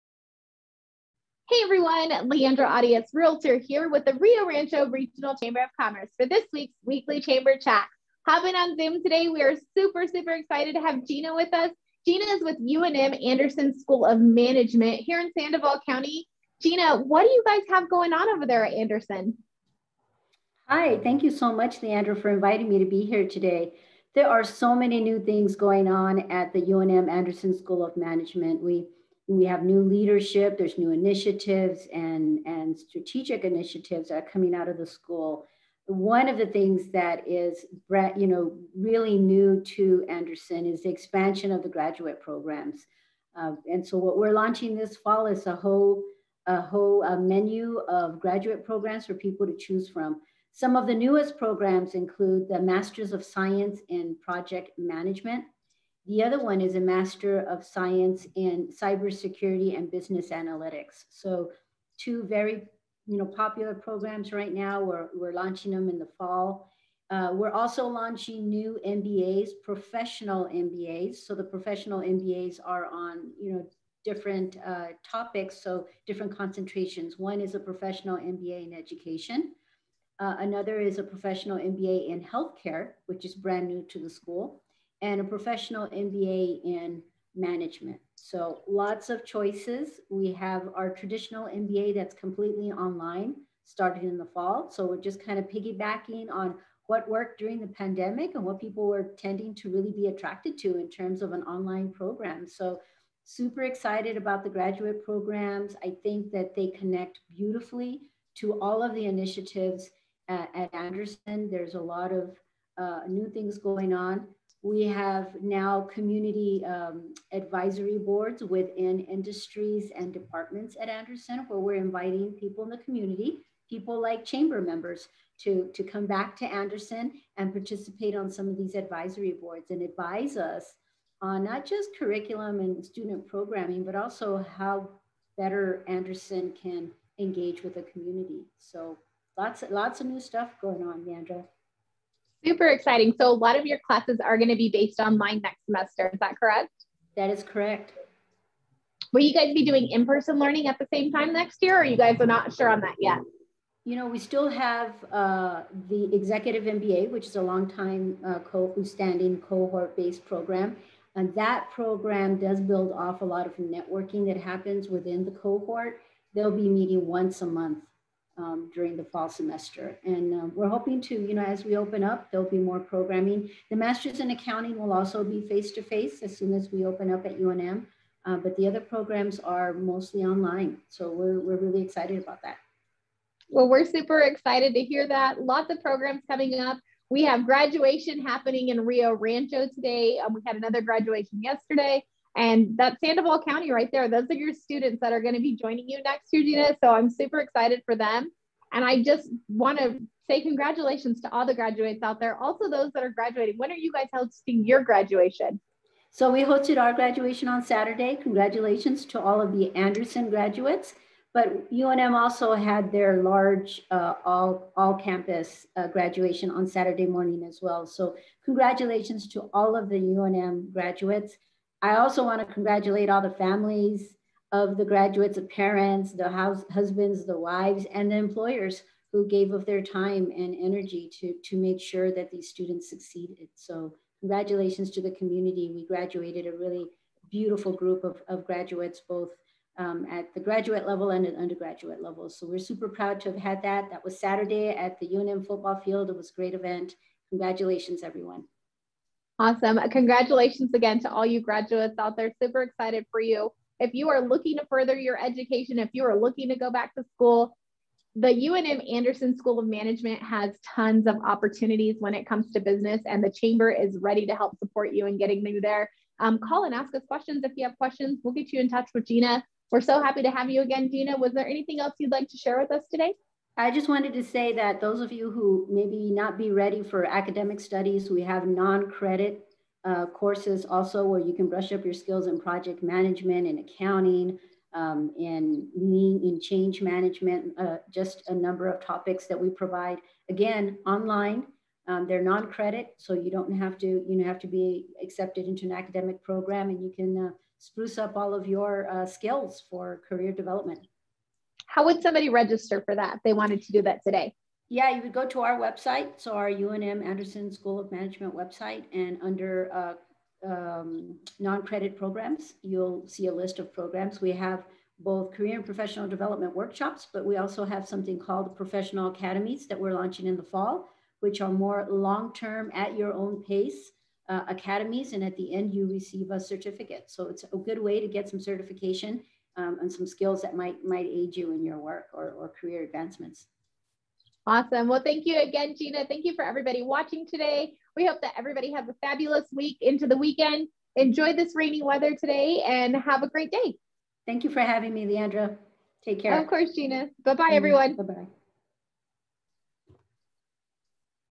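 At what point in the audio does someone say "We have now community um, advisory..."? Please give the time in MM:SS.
01:54.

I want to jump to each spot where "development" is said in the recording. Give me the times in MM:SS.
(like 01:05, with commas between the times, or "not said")
05:00, 05:16.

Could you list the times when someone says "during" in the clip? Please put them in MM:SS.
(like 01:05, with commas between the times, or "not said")
01:37, 02:48.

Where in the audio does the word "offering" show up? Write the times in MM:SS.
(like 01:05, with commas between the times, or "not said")
not said.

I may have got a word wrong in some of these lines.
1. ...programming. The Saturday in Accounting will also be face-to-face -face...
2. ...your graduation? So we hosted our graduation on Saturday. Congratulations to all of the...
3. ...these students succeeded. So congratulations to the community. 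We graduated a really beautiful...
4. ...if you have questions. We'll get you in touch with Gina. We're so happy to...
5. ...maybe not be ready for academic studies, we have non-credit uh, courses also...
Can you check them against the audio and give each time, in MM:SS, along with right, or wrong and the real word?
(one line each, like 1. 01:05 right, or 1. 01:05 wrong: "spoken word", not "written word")
1. 02:52 wrong: "Masters", not "Saturday"
2. 03:24 right
3. 03:52 right
4. 04:27 right
5. 04:35 right.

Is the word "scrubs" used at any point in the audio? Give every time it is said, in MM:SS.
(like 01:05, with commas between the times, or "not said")
not said.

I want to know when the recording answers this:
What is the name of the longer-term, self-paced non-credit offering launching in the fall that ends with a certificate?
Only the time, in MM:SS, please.
05:18.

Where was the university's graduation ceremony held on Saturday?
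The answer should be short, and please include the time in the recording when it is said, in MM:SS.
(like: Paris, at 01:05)
UNM football field, at 04:05.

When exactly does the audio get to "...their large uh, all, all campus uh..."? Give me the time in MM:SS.
03:32.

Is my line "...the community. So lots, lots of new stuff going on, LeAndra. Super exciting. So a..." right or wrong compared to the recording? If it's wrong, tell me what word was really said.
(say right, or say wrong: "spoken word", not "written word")
right.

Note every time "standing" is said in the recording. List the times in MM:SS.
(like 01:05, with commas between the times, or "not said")
02:38.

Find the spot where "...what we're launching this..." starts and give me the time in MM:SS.
00:43.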